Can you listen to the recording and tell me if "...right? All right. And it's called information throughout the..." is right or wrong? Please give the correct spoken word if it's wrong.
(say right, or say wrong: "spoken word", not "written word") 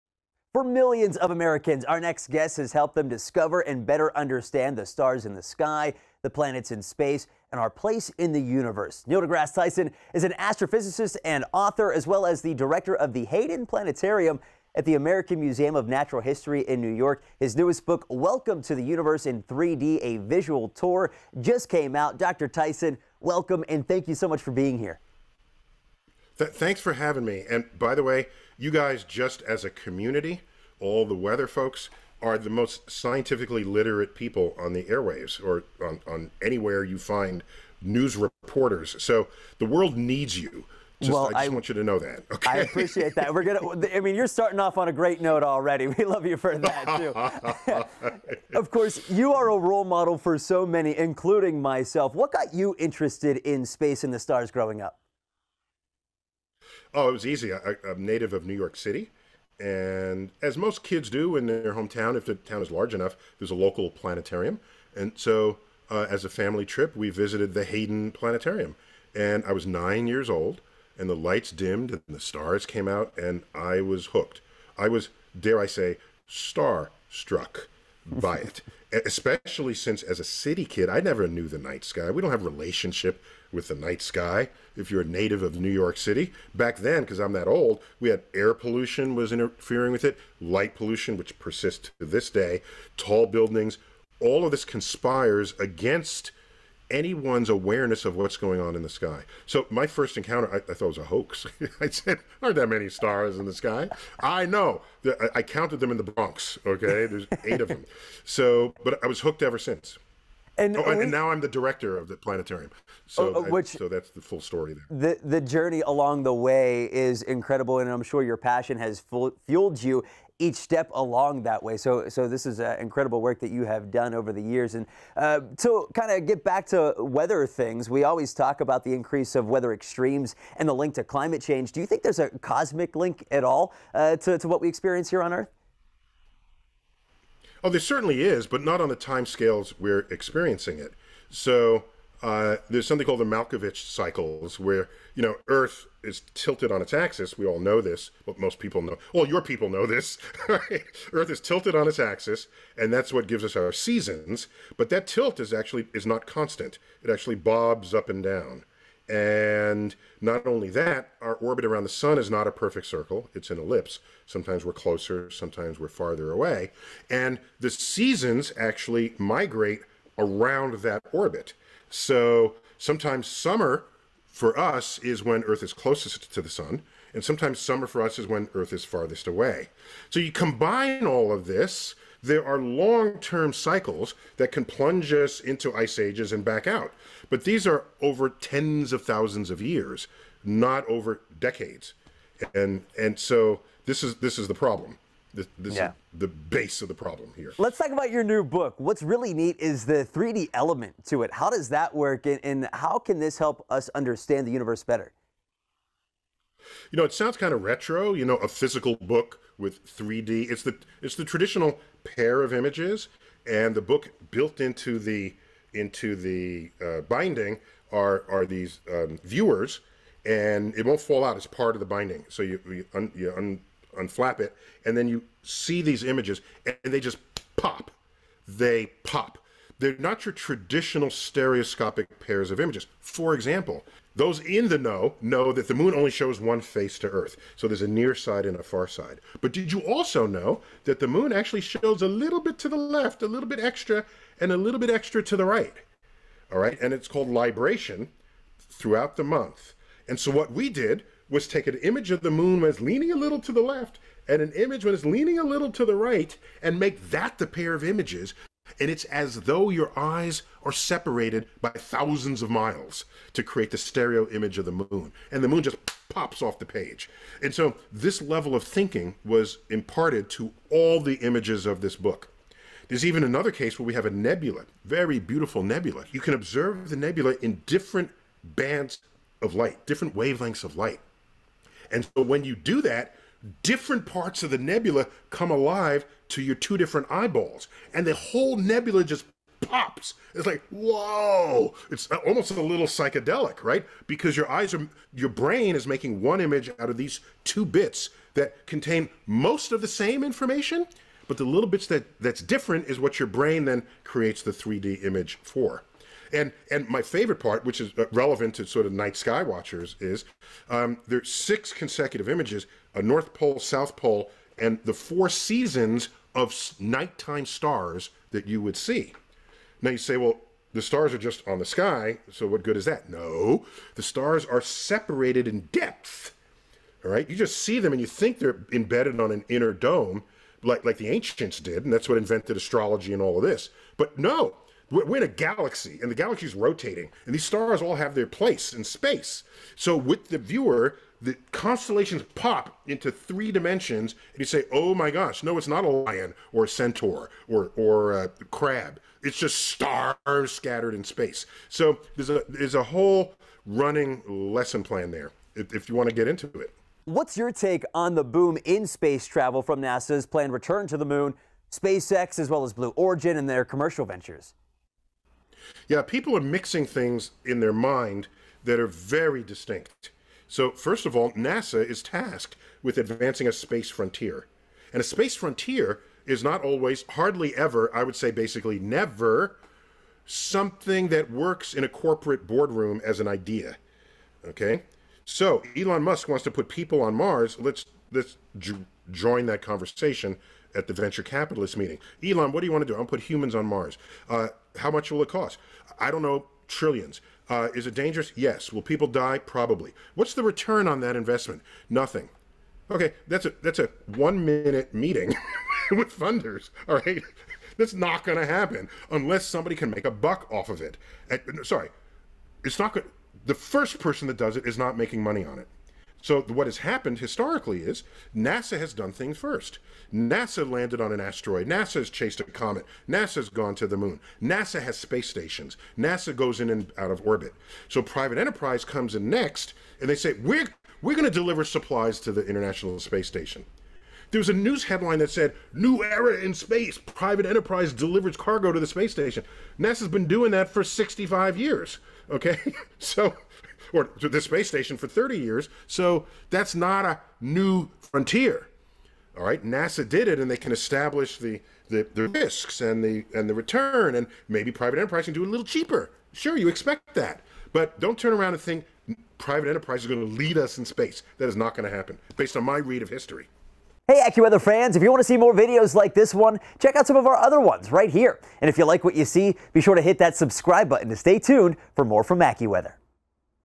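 wrong: "libration", not "information".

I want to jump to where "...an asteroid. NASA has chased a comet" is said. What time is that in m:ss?
7:01.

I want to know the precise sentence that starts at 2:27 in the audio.
We all know this, but most people know.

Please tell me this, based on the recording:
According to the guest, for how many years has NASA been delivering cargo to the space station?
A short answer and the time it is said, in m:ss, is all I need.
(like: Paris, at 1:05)
30 years, at 7:25.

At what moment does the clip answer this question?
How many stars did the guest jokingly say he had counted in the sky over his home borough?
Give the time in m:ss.
1:47.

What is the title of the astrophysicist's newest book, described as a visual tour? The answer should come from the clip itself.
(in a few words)
Welcome to the Universe in 3D.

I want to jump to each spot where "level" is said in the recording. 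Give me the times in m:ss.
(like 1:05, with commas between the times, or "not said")
4:28.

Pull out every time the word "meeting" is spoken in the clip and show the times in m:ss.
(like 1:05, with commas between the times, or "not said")
6:31, 6:44.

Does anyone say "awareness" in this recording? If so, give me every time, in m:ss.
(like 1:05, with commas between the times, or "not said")
1:37.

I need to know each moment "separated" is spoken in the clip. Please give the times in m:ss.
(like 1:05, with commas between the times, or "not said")
4:20, 5:24.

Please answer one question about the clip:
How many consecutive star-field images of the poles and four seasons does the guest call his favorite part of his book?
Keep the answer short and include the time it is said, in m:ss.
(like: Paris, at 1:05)
6, at 5:11.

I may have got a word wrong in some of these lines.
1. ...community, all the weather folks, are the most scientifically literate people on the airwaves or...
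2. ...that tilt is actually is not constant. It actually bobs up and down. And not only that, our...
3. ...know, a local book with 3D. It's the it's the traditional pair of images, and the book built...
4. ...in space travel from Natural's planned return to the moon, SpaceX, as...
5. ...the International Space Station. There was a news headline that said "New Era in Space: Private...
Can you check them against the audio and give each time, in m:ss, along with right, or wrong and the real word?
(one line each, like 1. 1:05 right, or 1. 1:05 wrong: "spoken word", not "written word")
1. 0:29 right
2. 2:34 right
3. 3:28 wrong: "physical", not "local"
4. 5:58 wrong: "NASA", not "Natural"
5. 7:12 right.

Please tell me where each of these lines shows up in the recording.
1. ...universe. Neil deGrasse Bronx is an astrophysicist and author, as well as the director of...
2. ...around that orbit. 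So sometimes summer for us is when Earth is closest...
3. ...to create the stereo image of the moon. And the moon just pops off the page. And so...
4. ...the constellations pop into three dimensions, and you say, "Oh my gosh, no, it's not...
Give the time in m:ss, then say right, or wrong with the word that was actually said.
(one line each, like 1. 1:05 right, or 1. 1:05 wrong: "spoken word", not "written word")
1. 0:08 wrong: "Tyson", not "Bronx"
2. 2:50 right
3. 4:23 right
4. 5:41 right.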